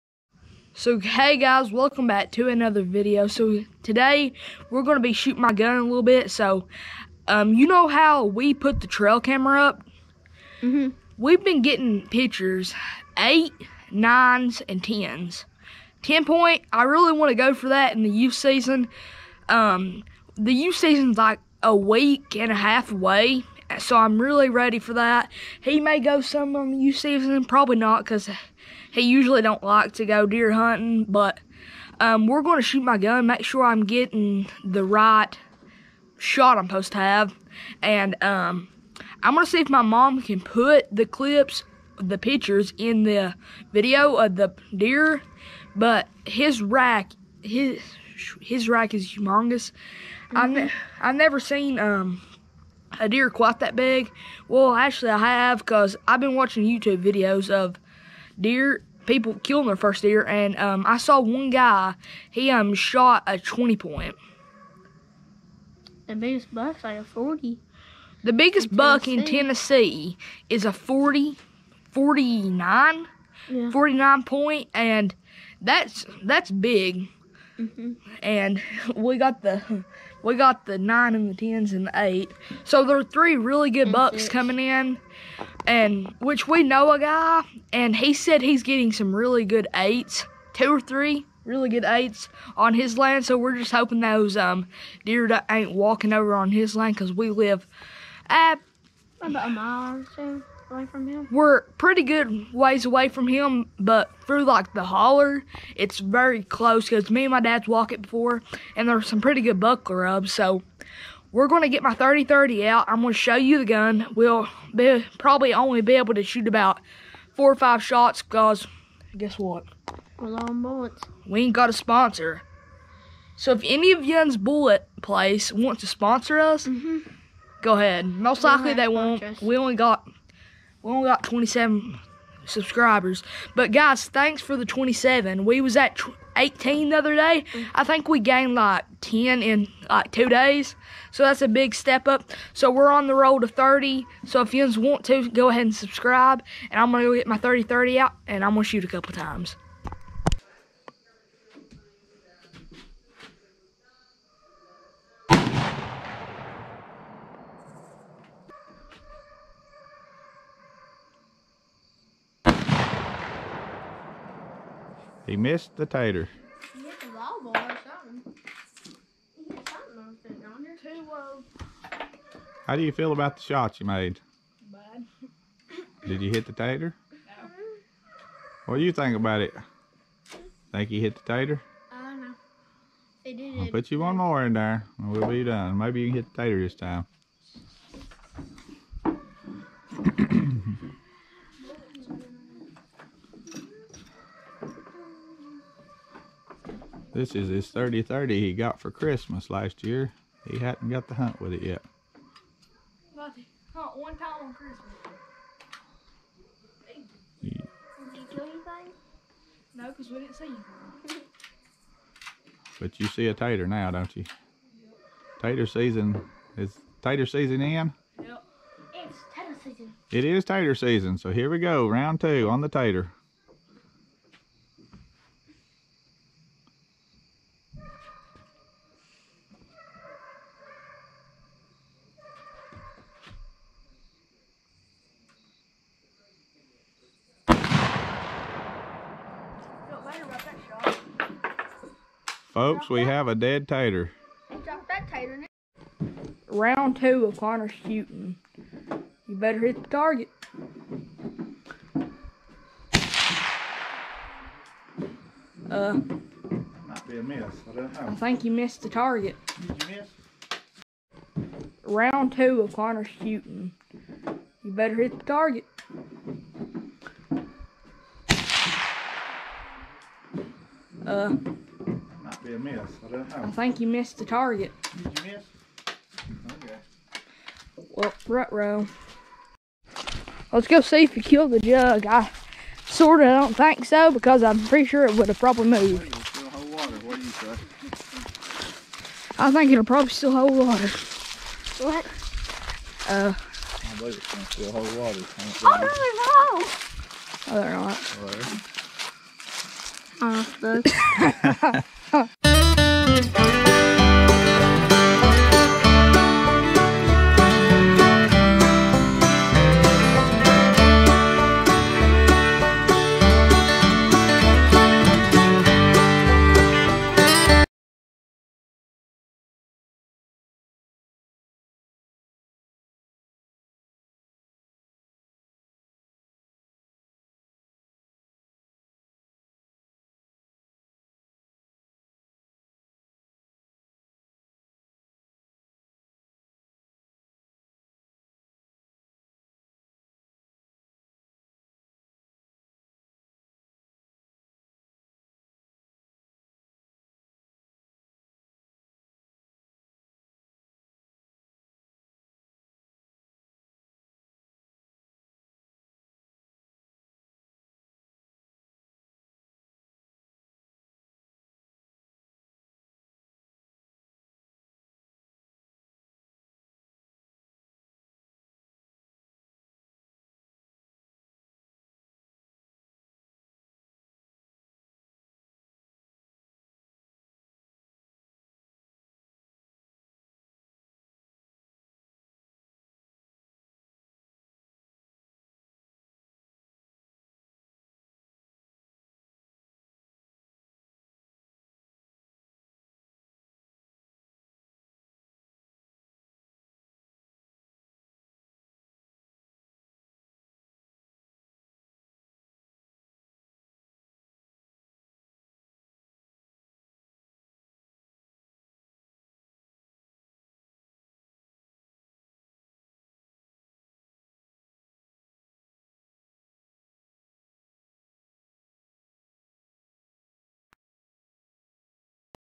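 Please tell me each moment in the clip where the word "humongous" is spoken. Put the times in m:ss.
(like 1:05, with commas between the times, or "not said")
0:49.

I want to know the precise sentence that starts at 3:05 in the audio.
Maybe you can hit the tater this time.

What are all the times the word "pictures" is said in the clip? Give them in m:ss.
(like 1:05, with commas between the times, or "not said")
0:12, 0:42.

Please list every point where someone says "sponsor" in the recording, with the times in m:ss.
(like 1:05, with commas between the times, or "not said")
2:01, 2:05.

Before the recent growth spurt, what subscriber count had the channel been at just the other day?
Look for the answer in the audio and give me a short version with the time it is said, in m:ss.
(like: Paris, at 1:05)
18, at 2:16.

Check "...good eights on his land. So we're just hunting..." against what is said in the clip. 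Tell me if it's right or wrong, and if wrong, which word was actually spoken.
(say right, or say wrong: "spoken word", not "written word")
wrong: "hoping", not "hunting".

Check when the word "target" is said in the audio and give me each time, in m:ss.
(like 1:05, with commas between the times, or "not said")
4:09, 4:18, 4:25, 4:34.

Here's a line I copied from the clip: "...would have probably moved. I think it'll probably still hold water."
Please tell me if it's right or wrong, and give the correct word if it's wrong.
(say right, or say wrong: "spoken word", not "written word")
right.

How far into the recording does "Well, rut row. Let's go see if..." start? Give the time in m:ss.
4:37.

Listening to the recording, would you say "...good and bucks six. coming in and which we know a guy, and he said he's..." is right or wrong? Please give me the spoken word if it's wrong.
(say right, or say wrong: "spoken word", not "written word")
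right.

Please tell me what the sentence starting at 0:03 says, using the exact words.
So today we're gonna be shooting my gun a little bit.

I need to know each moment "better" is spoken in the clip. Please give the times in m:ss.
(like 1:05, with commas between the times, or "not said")
4:09, 4:24.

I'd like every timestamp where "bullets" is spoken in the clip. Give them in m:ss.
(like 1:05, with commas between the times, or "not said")
2:00, 2:04.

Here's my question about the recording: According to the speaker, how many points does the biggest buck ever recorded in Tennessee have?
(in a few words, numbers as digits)
49.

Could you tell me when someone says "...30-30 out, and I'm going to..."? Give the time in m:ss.
2:27.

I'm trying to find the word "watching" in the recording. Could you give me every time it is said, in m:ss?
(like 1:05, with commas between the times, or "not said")
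0:56.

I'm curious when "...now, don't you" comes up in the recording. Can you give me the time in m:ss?
3:33.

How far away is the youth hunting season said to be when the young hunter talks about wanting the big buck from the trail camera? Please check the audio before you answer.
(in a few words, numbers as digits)
a week and a half.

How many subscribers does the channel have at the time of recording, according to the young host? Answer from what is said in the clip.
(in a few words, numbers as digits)
27.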